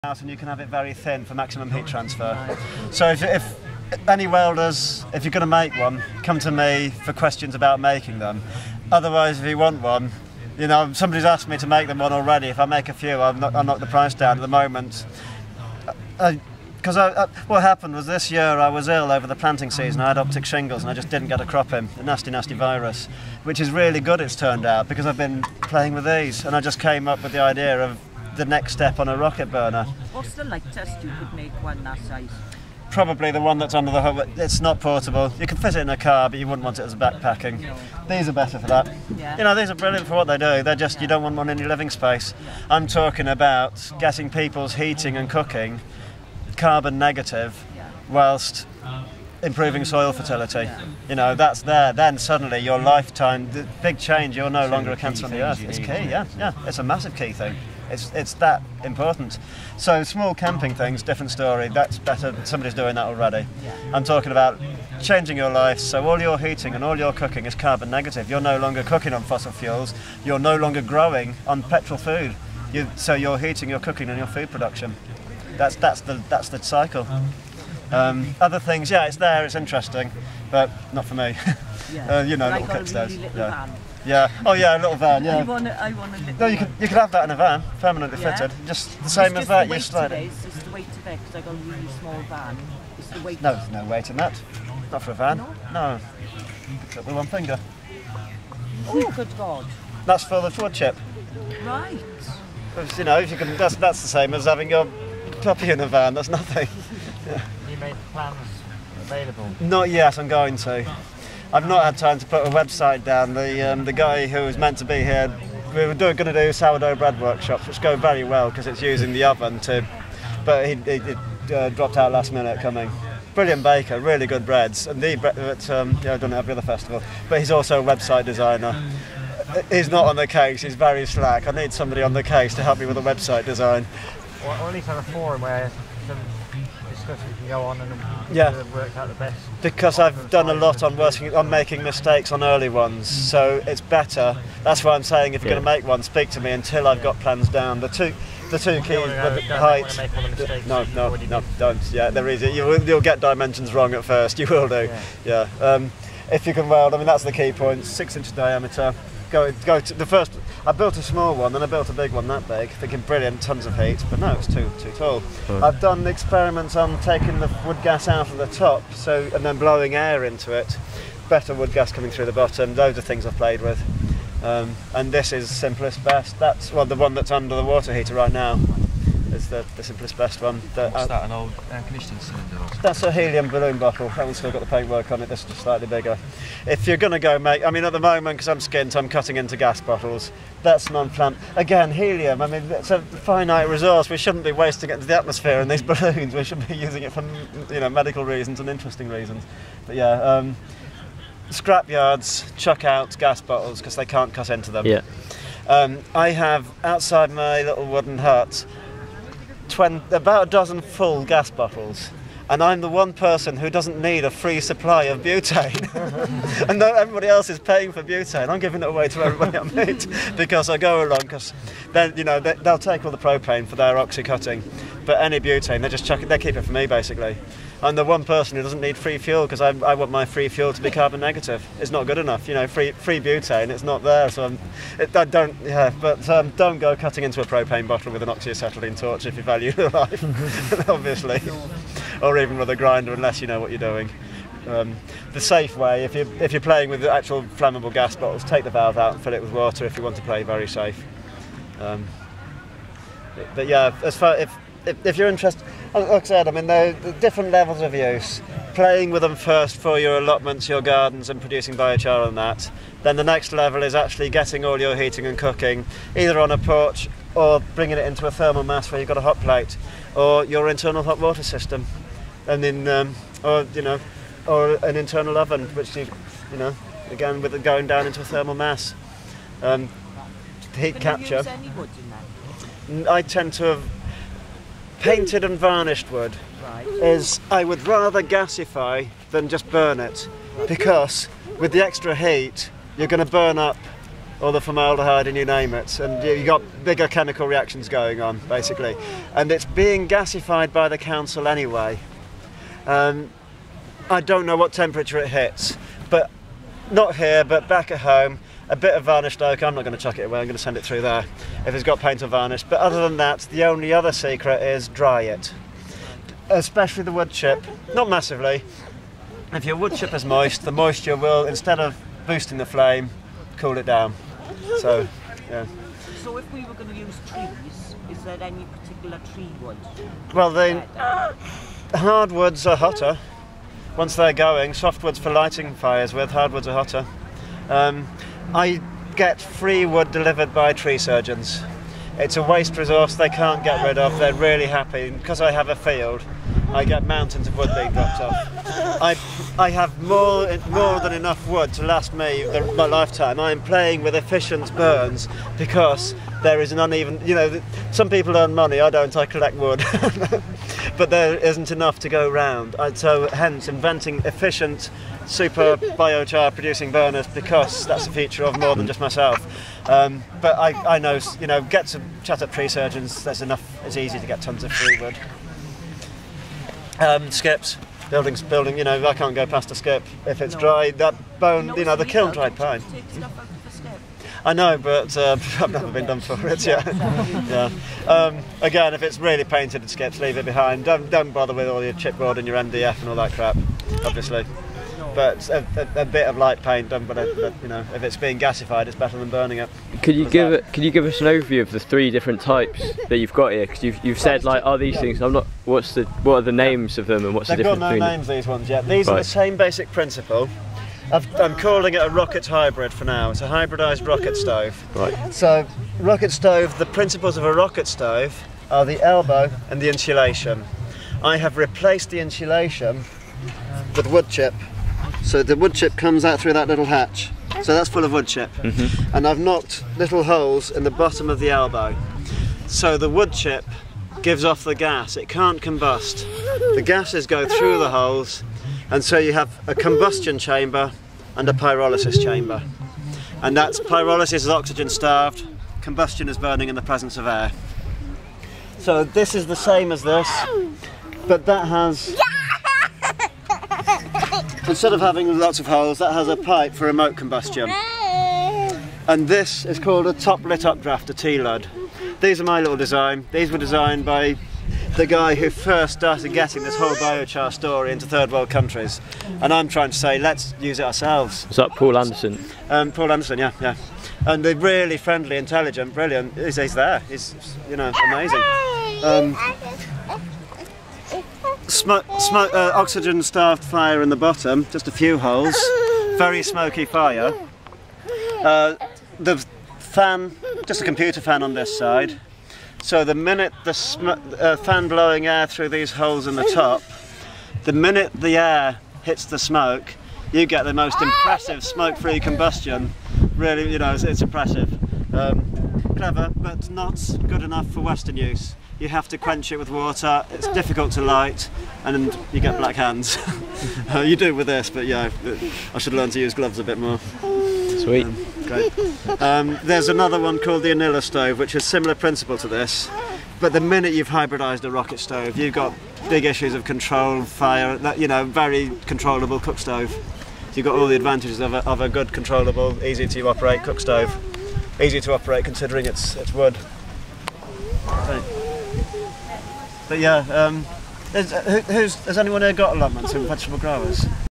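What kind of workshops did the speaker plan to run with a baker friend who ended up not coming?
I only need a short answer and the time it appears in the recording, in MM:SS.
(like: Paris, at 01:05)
Sourdough bread workshops, at 01:56.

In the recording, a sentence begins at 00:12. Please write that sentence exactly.
If I make a few, I'll knock, knock the price down at the moment.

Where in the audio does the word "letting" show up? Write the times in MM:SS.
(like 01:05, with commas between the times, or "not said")
not said.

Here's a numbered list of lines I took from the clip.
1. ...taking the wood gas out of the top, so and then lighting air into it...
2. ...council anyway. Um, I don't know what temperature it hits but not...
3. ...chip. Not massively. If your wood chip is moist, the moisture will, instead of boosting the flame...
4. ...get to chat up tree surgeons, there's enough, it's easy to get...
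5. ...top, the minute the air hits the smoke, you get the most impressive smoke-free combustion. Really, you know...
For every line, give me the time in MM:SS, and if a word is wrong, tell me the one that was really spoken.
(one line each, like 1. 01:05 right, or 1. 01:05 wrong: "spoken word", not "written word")
1. 02:47 wrong: "blowing", not "lighting"
2. 05:00 right
3. 05:17 right
4. 06:11 right
5. 08:16 right.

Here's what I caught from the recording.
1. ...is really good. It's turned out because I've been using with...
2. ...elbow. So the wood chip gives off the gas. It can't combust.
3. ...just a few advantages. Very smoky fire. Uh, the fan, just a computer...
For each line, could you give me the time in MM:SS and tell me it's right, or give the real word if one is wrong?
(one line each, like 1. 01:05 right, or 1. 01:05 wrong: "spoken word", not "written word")
1. 00:23 wrong: "playing", not "using"
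2. 07:11 right
3. 08:04 wrong: "holes", not "advantages".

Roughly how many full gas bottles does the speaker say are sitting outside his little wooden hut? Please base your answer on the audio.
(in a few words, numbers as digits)
About a dozen.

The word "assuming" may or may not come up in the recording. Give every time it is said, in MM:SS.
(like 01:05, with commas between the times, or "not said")
not said.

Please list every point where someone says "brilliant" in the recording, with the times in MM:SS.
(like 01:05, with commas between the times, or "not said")
00:39, 02:03, 02:43, 07:55.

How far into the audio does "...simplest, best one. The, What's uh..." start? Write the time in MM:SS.
02:59.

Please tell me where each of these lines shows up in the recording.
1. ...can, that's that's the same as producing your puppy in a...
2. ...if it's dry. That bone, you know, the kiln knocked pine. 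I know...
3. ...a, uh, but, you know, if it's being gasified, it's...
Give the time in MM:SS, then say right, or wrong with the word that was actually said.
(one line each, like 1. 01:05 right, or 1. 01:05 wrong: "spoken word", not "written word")
1. 01:43 wrong: "having", not "producing"
2. 06:20 wrong: "dried", not "knocked"
3. 06:37 right.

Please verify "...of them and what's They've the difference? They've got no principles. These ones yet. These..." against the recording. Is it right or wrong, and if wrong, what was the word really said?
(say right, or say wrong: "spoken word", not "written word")
wrong: "names", not "principles".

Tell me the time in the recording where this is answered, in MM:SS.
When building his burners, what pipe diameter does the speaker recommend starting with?
02:37.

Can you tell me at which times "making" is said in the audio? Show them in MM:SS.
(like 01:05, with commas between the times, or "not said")
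00:07, 02:21.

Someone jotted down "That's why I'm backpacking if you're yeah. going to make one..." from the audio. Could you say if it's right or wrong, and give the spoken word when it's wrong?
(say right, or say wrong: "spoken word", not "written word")
wrong: "saying", not "backpacking".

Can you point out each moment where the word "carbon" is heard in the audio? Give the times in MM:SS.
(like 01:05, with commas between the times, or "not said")
00:46, 01:07, 03:50.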